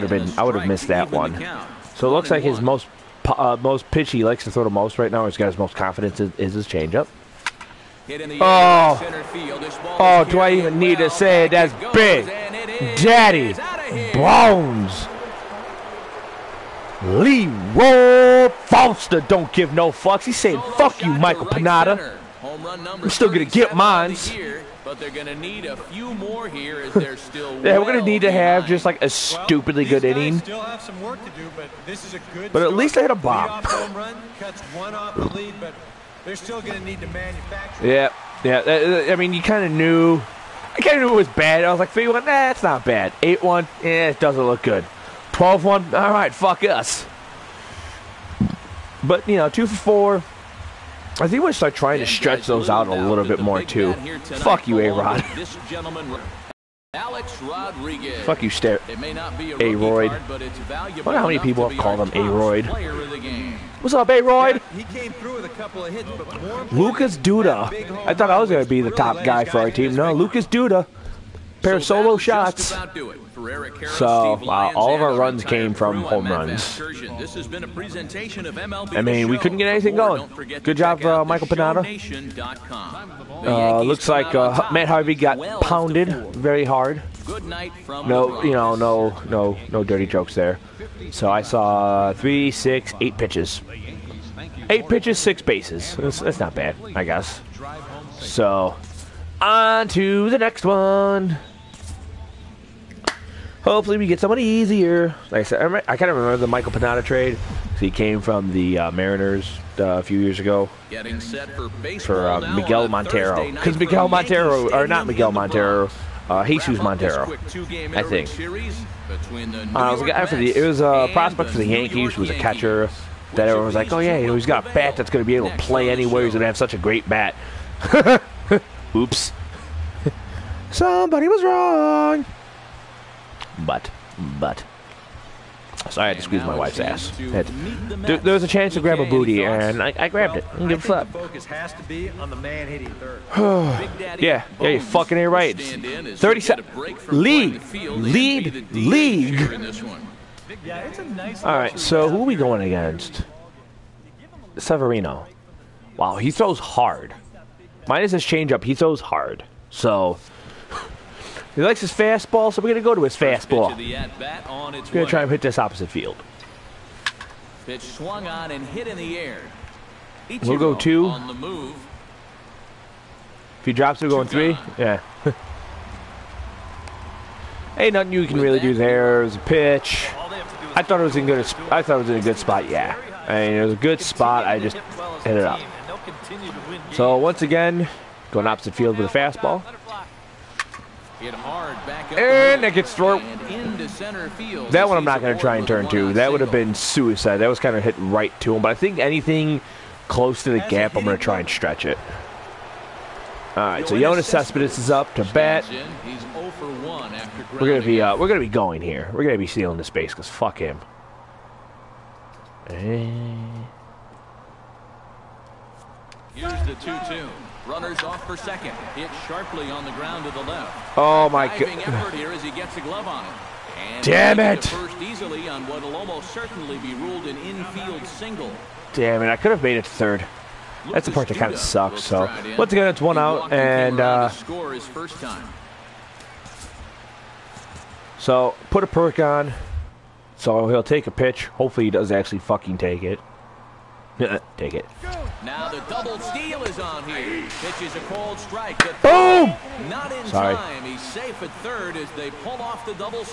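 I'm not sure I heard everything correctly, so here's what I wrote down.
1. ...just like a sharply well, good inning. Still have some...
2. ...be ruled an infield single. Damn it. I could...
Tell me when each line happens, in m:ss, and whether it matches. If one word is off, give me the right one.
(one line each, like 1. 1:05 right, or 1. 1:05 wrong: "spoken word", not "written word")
1. 0:28 wrong: "stupidly", not "sharply"
2. 3:46 right.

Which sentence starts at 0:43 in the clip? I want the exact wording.
8 1, eh, it doesn't look good.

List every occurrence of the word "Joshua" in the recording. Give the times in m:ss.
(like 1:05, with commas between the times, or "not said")
not said.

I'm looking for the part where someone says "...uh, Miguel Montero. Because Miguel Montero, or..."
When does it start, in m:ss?
1:52.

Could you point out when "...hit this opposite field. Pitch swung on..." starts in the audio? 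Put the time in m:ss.
2:45.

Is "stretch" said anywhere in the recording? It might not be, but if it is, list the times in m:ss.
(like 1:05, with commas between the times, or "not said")
0:52, 3:21.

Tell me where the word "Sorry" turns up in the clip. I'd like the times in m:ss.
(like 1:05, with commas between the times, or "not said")
2:15, 4:10.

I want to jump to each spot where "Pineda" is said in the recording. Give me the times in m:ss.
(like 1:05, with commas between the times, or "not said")
0:21, 1:21, 1:46.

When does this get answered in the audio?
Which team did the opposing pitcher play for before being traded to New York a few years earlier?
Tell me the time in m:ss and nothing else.
1:48.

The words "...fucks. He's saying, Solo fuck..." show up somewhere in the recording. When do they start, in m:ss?
0:19.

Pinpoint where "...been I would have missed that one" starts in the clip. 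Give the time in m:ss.
0:00.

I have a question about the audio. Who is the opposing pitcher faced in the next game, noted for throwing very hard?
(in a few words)
Severino.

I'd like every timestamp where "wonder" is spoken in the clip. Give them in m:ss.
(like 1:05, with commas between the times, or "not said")
1:01.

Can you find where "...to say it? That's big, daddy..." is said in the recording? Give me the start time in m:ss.
0:10.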